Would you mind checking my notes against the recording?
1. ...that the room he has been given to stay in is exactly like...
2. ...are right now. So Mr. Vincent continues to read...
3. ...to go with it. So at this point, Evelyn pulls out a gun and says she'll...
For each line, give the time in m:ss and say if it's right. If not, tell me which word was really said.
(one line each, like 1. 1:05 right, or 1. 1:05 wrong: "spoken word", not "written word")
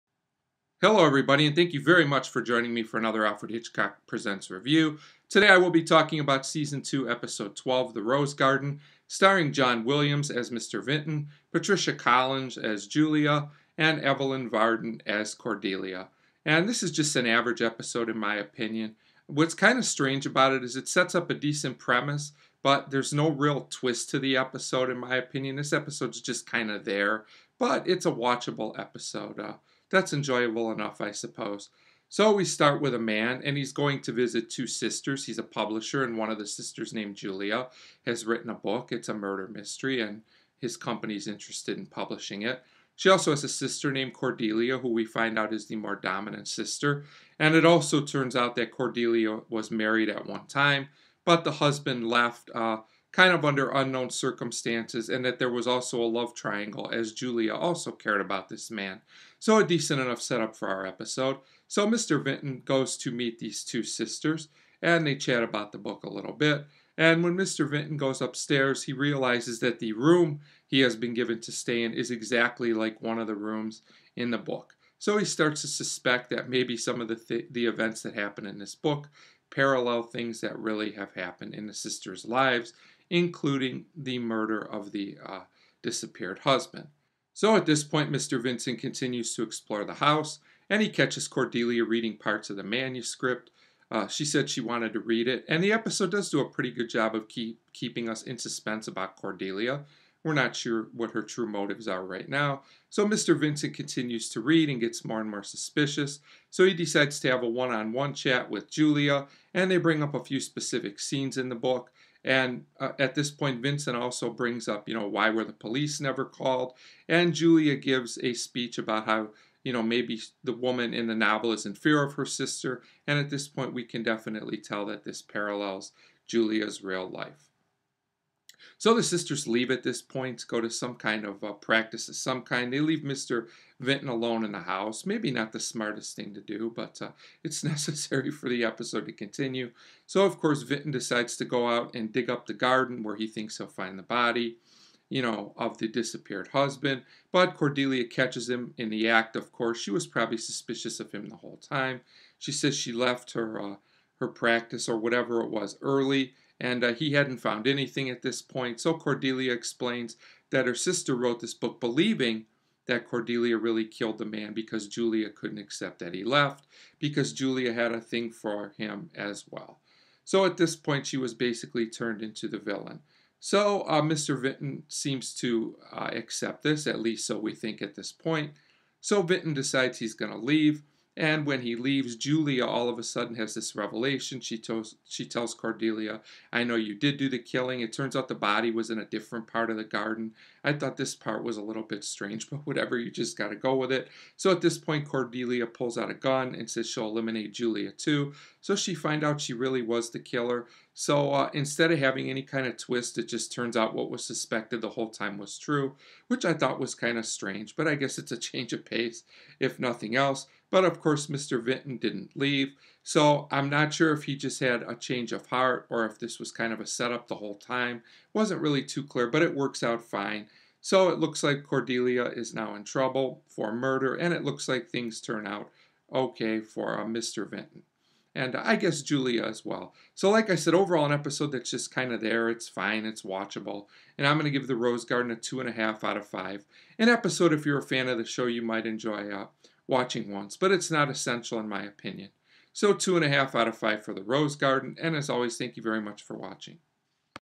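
1. 1:09 right
2. 1:41 right
3. 3:13 wrong: "Cordelia", not "Evelyn".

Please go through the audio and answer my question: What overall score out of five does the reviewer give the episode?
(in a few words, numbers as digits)
2.5.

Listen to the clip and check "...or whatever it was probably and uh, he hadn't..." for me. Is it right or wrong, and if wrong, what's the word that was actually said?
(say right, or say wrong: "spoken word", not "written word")
wrong: "early", not "probably".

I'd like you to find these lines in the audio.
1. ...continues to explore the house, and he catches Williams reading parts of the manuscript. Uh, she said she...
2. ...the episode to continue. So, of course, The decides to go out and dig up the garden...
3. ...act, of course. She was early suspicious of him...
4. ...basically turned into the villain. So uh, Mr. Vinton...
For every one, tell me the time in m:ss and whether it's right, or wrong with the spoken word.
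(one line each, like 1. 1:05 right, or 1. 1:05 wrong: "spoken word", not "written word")
1. 1:28 wrong: "Cordelia", not "Williams"
2. 2:18 wrong: "Vinton", not "The"
3. 2:29 wrong: "probably", not "early"
4. 2:51 right.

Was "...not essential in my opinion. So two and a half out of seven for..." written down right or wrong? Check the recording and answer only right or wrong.
wrong.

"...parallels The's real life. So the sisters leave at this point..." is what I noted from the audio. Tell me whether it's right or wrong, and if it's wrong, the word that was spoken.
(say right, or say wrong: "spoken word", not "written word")
wrong: "Julia", not "The".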